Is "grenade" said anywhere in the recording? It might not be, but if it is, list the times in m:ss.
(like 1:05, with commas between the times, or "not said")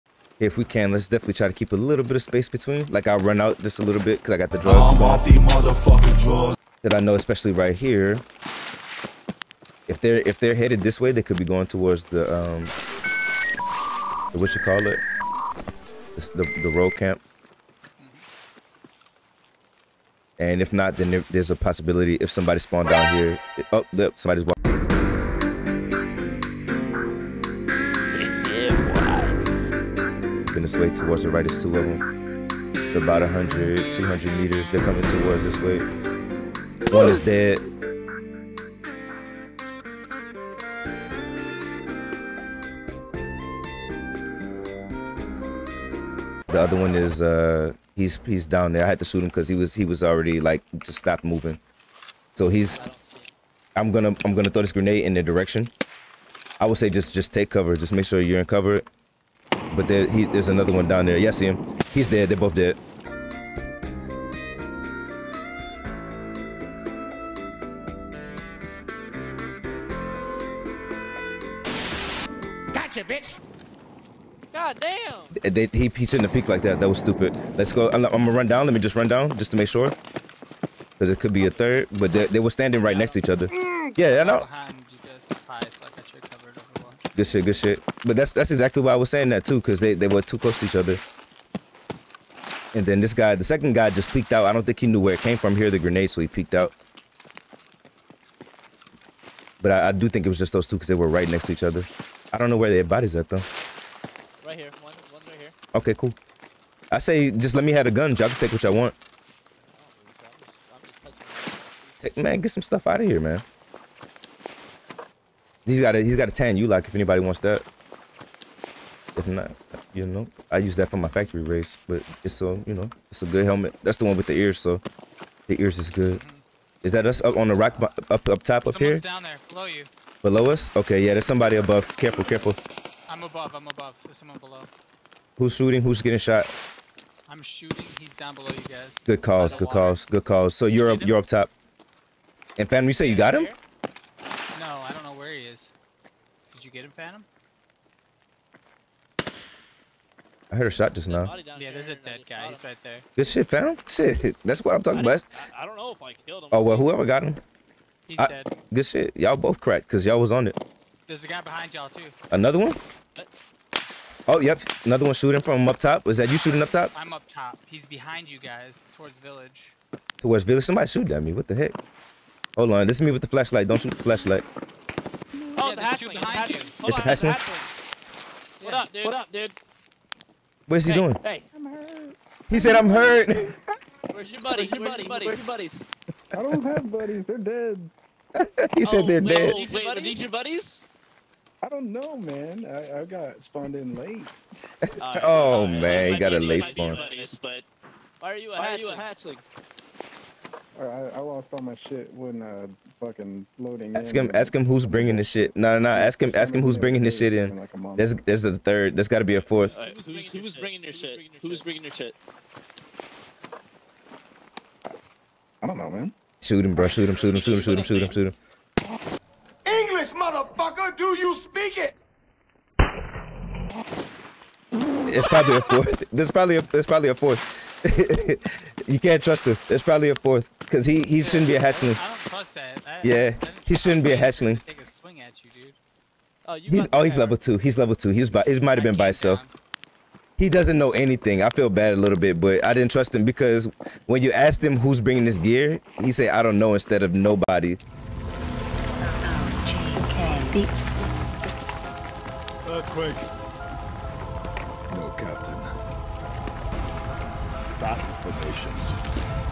0:54, 1:35.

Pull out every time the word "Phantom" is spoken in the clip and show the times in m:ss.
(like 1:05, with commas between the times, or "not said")
2:26, 2:33.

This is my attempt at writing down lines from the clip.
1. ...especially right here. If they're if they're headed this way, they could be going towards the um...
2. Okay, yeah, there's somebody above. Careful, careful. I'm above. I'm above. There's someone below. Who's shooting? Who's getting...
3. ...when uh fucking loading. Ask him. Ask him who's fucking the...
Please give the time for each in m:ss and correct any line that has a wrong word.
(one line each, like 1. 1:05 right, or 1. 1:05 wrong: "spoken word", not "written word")
1. 0:07 right
2. 2:10 right
3. 3:22 wrong: "bringing", not "fucking".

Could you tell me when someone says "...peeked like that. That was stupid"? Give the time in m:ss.
1:16.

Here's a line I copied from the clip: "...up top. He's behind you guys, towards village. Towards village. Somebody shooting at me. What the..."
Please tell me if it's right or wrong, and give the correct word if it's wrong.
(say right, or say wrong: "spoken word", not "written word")
right.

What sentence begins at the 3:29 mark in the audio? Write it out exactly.
Right, who's, who's bringing your shit?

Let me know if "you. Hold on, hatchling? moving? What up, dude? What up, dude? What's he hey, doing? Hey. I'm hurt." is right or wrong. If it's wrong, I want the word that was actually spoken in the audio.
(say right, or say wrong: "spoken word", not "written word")
wrong: "hatchling", not "moving".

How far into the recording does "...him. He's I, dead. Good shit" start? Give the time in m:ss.
2:37.